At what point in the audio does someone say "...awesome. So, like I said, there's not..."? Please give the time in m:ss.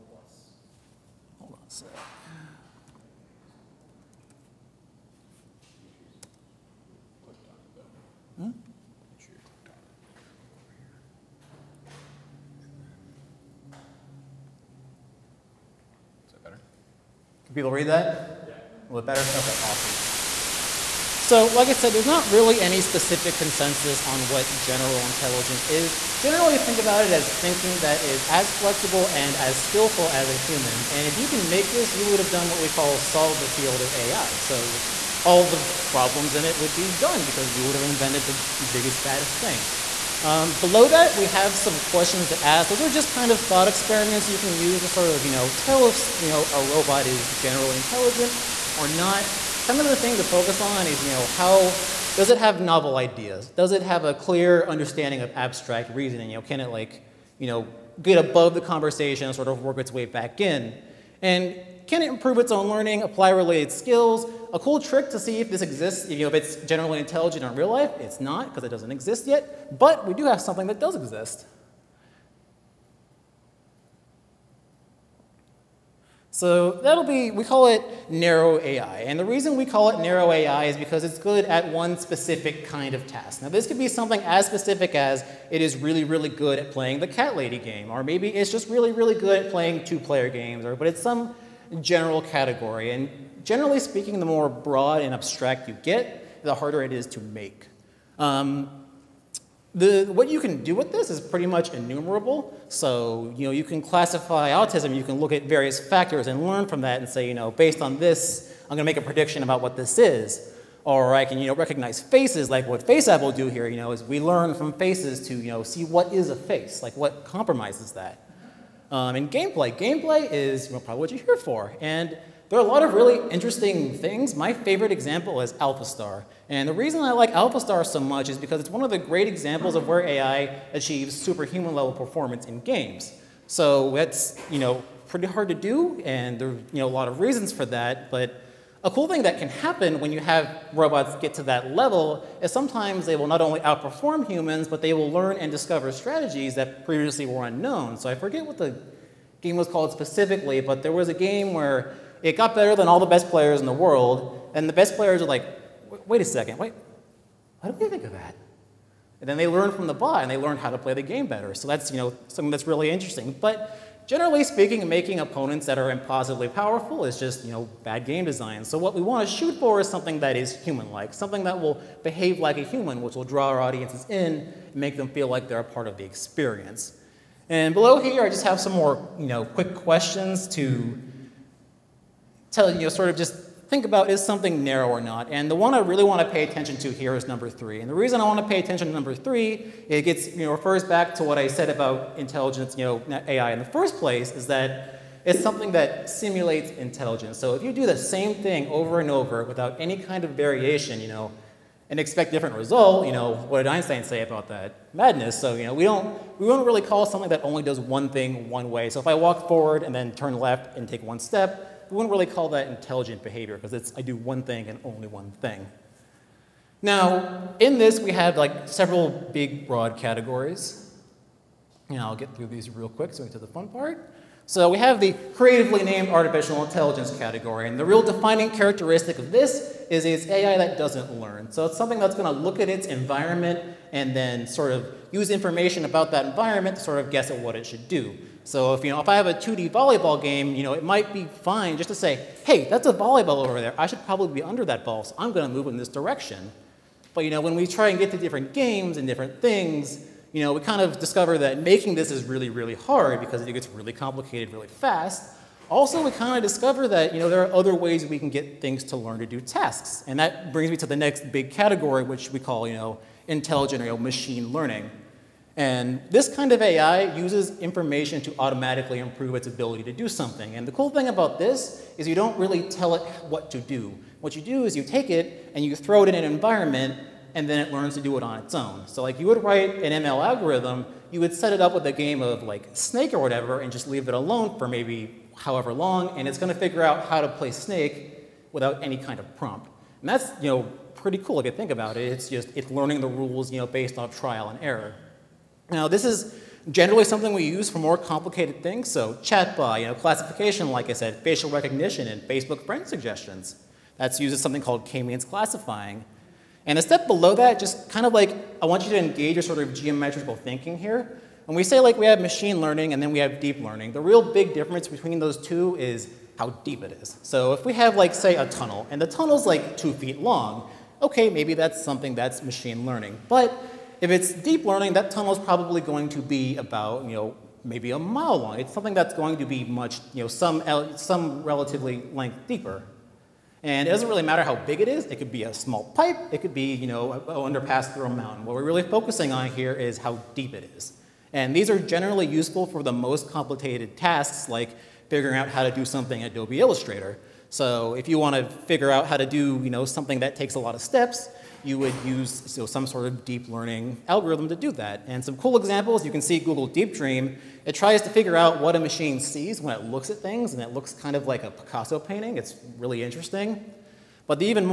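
0:19.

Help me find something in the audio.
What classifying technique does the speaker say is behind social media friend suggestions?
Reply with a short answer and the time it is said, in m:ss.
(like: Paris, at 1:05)
k-means classifying, at 5:04.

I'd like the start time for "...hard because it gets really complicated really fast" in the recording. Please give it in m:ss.
4:12.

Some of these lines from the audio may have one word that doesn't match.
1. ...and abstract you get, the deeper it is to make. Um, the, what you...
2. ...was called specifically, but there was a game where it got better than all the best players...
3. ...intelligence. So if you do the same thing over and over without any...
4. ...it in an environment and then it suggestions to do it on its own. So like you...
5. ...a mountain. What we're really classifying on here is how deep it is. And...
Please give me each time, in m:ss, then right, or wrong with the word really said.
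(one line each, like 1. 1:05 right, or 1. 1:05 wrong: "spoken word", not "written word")
1. 1:35 wrong: "harder", not "deeper"
2. 2:29 right
3. 3:16 right
4. 4:36 wrong: "learns", not "suggestions"
5. 5:38 wrong: "focusing", not "classifying".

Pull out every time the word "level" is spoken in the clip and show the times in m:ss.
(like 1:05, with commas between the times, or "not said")
2:11, 2:21.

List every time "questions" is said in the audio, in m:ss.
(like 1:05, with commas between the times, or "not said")
0:41, 2:59.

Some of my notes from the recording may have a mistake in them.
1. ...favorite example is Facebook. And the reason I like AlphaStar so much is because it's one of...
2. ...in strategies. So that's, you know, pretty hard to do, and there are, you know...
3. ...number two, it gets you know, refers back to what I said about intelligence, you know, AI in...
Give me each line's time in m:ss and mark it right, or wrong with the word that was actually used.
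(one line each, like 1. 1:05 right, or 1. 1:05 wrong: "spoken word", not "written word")
1. 2:04 wrong: "AlphaStar", not "Facebook"
2. 2:12 wrong: "games", not "strategies"
3. 3:08 wrong: "three", not "two".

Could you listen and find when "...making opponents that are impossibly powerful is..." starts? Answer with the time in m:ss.
2:44.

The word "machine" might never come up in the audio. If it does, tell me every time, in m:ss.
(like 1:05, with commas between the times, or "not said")
4:23, 5:12, 5:22, 5:58.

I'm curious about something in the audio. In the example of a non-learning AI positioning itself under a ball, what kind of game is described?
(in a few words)
2D volleyball game.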